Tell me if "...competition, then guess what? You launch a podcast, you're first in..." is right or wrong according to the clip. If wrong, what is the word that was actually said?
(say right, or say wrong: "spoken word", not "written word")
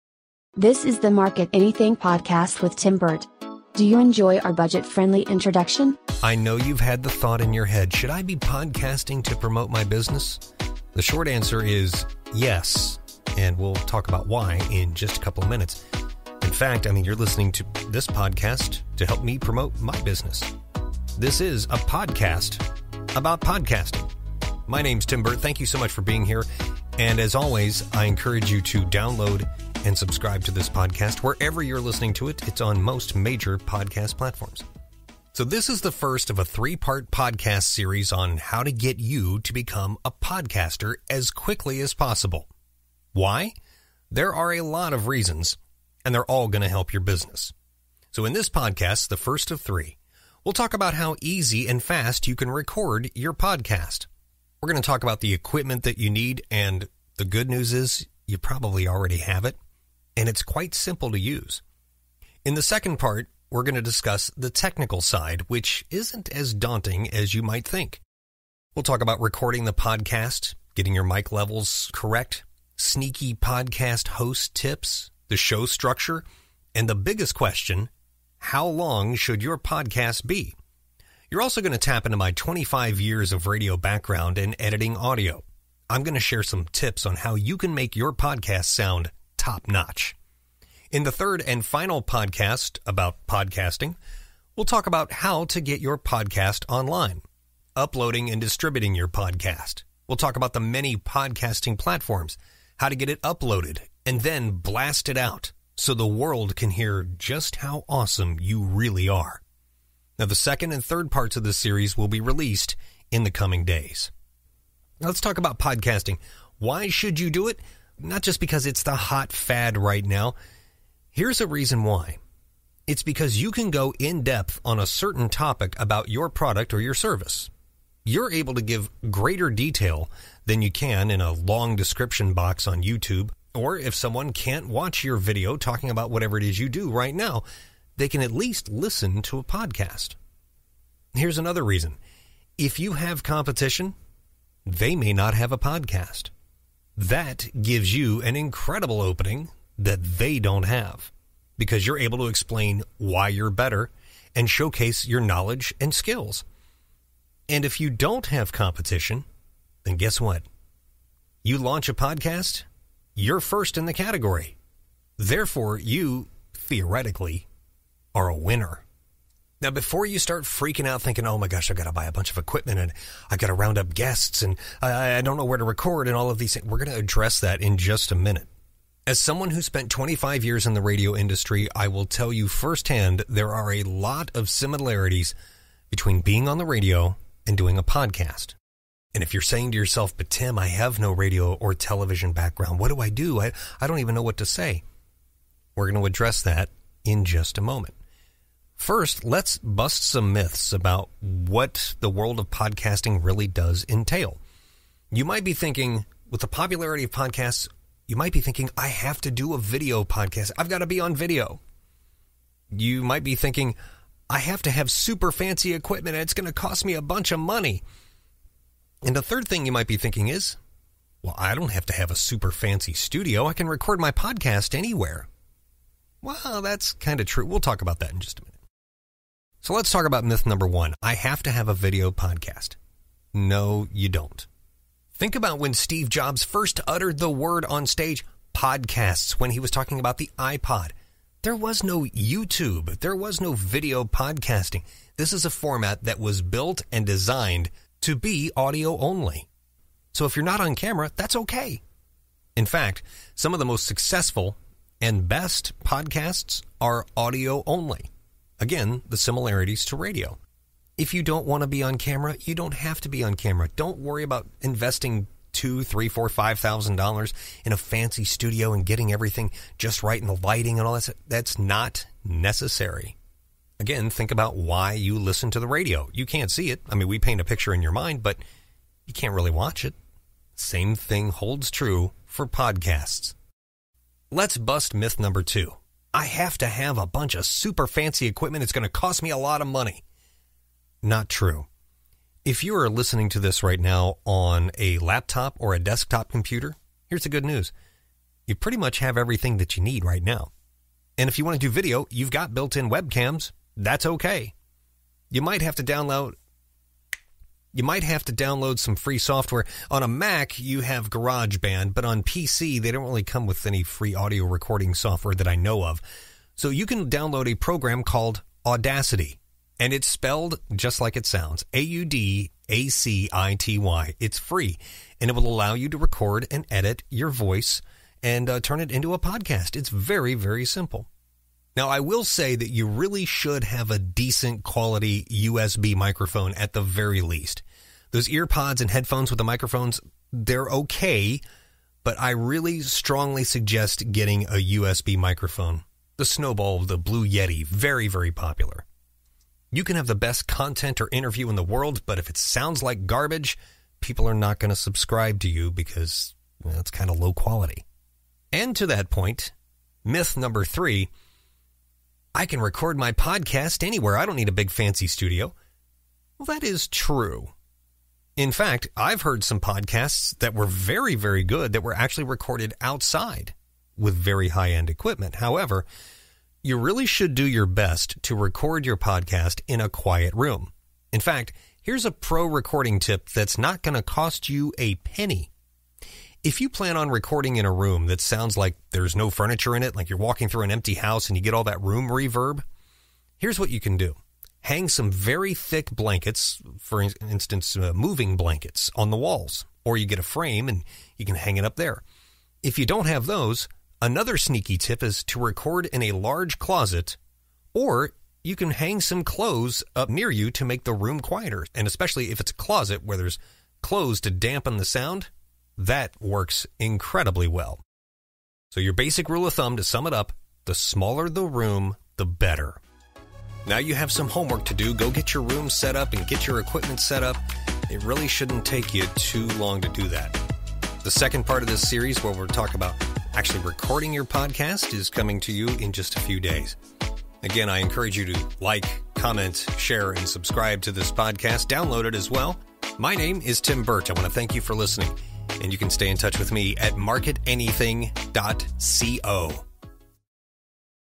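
right.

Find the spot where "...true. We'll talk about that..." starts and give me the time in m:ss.
3:47.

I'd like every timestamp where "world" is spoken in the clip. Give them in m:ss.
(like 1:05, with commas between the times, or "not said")
1:46, 3:22, 5:51.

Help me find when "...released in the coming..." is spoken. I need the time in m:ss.
1:52.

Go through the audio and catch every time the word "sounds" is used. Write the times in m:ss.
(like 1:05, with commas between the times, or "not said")
1:28, 5:21, 5:52, 6:28, 6:54.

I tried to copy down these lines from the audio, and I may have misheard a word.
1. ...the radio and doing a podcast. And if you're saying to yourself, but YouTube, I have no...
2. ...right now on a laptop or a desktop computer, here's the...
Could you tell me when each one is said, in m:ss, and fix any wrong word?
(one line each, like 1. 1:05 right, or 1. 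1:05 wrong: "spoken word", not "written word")
1. 3:06 wrong: "Tim", not "YouTube"
2. 4:53 right.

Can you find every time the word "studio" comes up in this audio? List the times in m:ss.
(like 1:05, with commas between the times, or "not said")
3:42, 4:28, 6:05.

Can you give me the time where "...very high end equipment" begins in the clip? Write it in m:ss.
6:14.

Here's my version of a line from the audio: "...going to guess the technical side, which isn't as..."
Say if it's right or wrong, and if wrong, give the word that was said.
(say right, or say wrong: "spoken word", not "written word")
wrong: "discuss", not "guess".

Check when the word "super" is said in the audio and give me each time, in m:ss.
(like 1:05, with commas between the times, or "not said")
3:34, 3:42, 4:47.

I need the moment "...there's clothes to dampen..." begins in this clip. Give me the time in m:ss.
6:53.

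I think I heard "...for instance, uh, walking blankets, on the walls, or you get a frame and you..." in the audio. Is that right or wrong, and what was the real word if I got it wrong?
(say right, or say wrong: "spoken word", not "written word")
wrong: "moving", not "walking".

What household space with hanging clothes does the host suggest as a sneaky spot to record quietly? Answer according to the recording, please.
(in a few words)
large closet.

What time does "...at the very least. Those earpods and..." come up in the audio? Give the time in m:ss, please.
5:36.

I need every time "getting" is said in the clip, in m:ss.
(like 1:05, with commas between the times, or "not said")
1:10, 4:28, 5:44.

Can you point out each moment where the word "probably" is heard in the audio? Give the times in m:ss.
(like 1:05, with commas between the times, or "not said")
0:58.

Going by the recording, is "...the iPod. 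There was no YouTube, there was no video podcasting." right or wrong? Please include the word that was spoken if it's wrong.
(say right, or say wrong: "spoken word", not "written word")
right.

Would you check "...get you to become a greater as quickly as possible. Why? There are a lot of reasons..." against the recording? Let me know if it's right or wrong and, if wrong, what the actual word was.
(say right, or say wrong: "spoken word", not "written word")
wrong: "podcaster", not "greater".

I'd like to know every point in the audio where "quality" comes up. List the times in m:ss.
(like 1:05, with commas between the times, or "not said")
5:34, 5:57.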